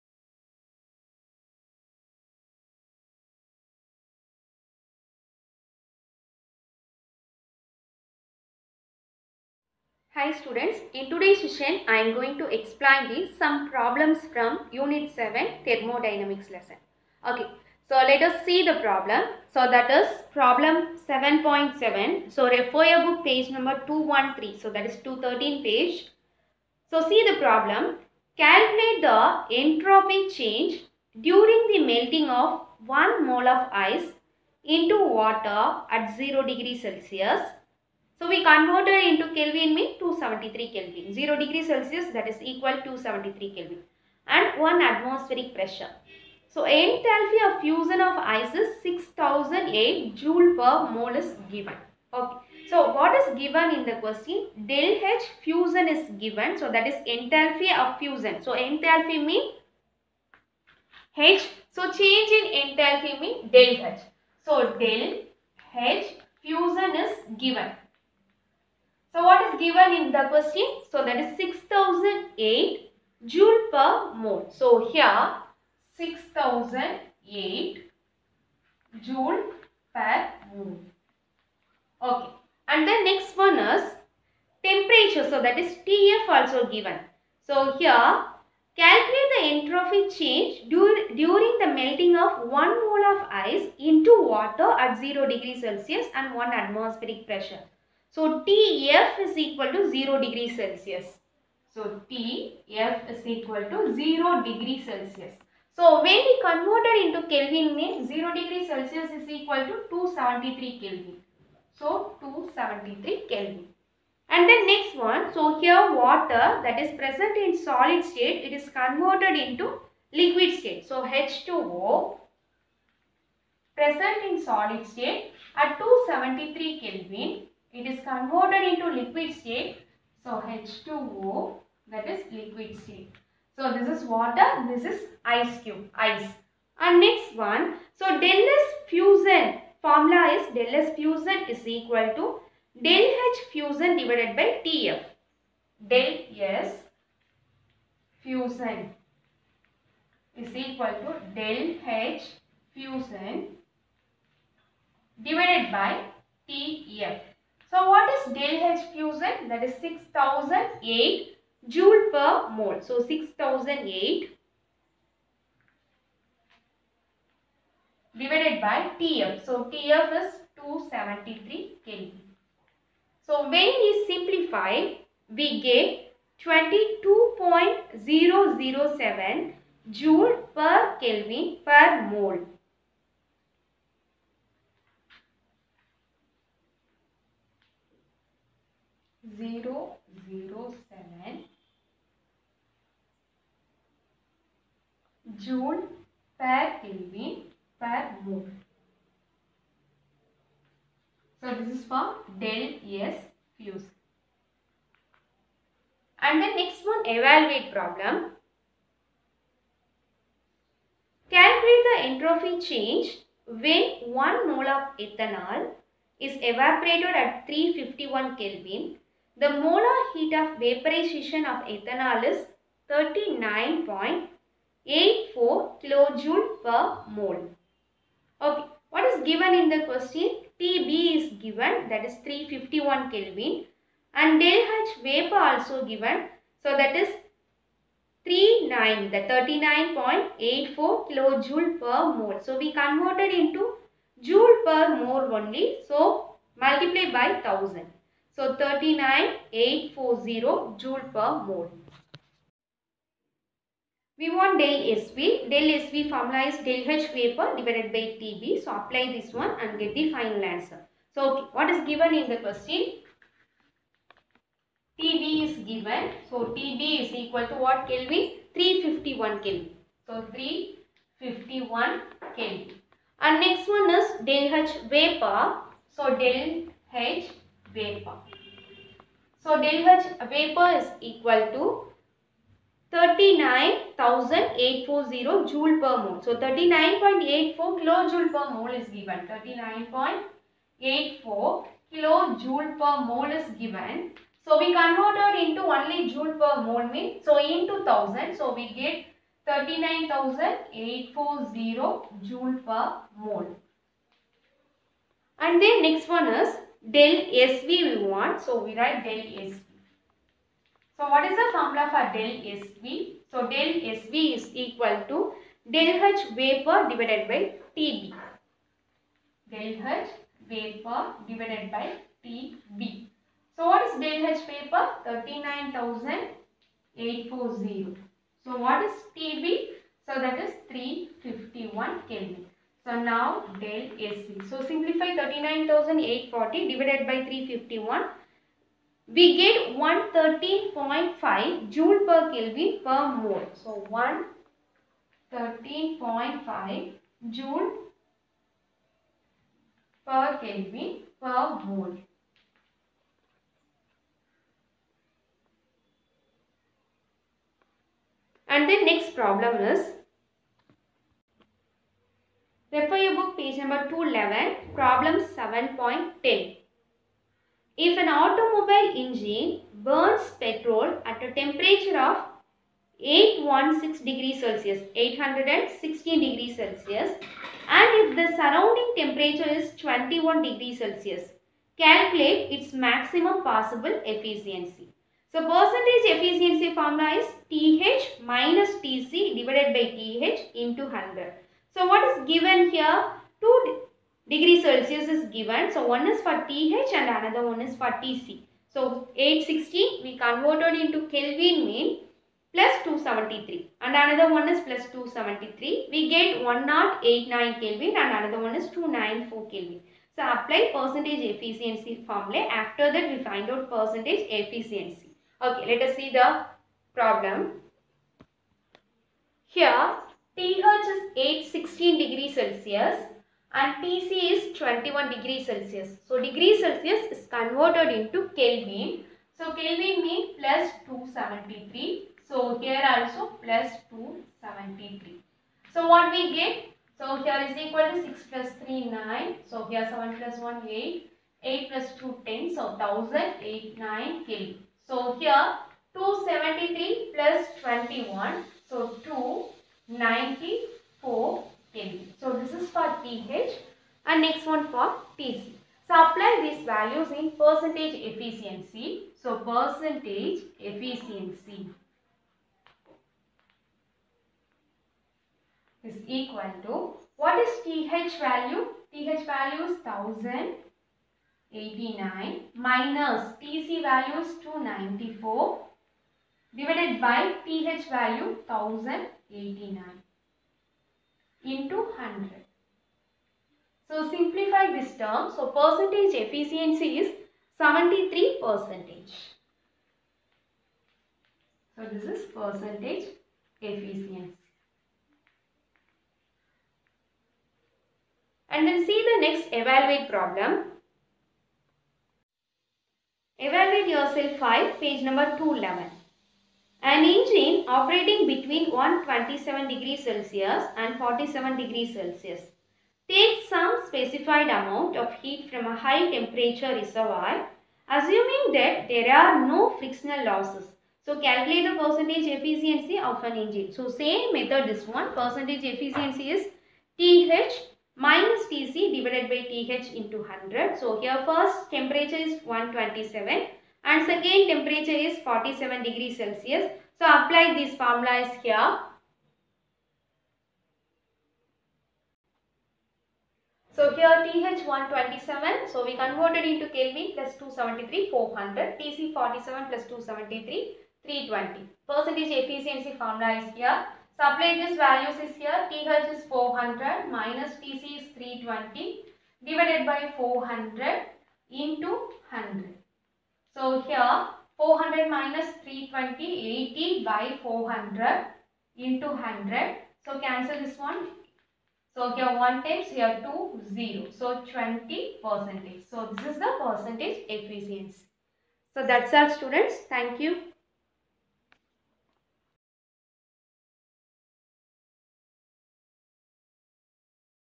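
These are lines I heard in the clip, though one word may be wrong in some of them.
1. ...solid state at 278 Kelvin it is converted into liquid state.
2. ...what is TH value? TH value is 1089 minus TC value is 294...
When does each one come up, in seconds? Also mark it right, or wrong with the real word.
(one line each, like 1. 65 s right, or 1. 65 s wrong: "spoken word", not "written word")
1. 124 s wrong: "273", not "278"
2. 467 s right.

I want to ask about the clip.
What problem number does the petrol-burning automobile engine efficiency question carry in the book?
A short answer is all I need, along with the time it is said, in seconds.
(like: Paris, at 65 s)
7.10, at 365 s.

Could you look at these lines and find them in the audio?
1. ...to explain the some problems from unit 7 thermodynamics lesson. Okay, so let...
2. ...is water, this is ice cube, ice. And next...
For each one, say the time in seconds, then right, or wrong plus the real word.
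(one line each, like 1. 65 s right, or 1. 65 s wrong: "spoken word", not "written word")
1. 12 s right
2. 133 s right.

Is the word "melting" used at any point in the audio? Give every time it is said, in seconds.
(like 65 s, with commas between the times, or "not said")
31 s, 91 s.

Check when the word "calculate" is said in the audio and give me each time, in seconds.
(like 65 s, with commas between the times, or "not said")
28 s, 88 s, 211 s, 381 s, 521 s.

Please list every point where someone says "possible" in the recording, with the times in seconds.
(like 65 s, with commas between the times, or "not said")
383 s.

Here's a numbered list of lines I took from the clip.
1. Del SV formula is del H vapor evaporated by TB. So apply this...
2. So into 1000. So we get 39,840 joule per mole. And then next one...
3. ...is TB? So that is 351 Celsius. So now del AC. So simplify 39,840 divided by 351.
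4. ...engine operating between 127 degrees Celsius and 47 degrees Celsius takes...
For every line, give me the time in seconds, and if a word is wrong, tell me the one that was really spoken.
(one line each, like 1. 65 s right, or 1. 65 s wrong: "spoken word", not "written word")
1. 255 s wrong: "divided", not "evaporated"
2. 297 s right
3. 328 s wrong: "Kelvin", not "Celsius"
4. 507 s right.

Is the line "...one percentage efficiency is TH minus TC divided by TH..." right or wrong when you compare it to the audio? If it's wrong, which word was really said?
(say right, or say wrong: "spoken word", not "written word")
right.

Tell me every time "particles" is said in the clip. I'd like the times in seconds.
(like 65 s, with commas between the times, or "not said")
not said.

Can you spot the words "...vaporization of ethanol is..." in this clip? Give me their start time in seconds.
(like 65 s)
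220 s.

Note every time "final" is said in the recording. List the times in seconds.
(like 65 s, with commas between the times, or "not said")
260 s.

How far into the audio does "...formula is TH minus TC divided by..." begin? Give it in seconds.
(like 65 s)
386 s.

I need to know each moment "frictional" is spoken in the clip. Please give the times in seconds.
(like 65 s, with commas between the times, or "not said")
519 s.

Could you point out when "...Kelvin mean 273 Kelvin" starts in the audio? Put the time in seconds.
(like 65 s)
39 s.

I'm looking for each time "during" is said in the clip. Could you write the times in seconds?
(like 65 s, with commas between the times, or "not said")
31 s, 91 s.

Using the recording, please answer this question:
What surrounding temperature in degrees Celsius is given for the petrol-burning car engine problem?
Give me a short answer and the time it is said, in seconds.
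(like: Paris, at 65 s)
21 degrees Celsius, at 379 s.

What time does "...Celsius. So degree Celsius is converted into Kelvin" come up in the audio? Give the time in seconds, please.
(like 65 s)
425 s.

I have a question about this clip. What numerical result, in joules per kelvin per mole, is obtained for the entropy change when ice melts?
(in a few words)
22.007.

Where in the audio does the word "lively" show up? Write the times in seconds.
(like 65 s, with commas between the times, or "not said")
not said.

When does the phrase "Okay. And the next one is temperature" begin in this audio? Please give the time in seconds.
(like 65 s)
82 s.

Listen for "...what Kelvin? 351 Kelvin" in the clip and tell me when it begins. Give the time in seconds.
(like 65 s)
267 s.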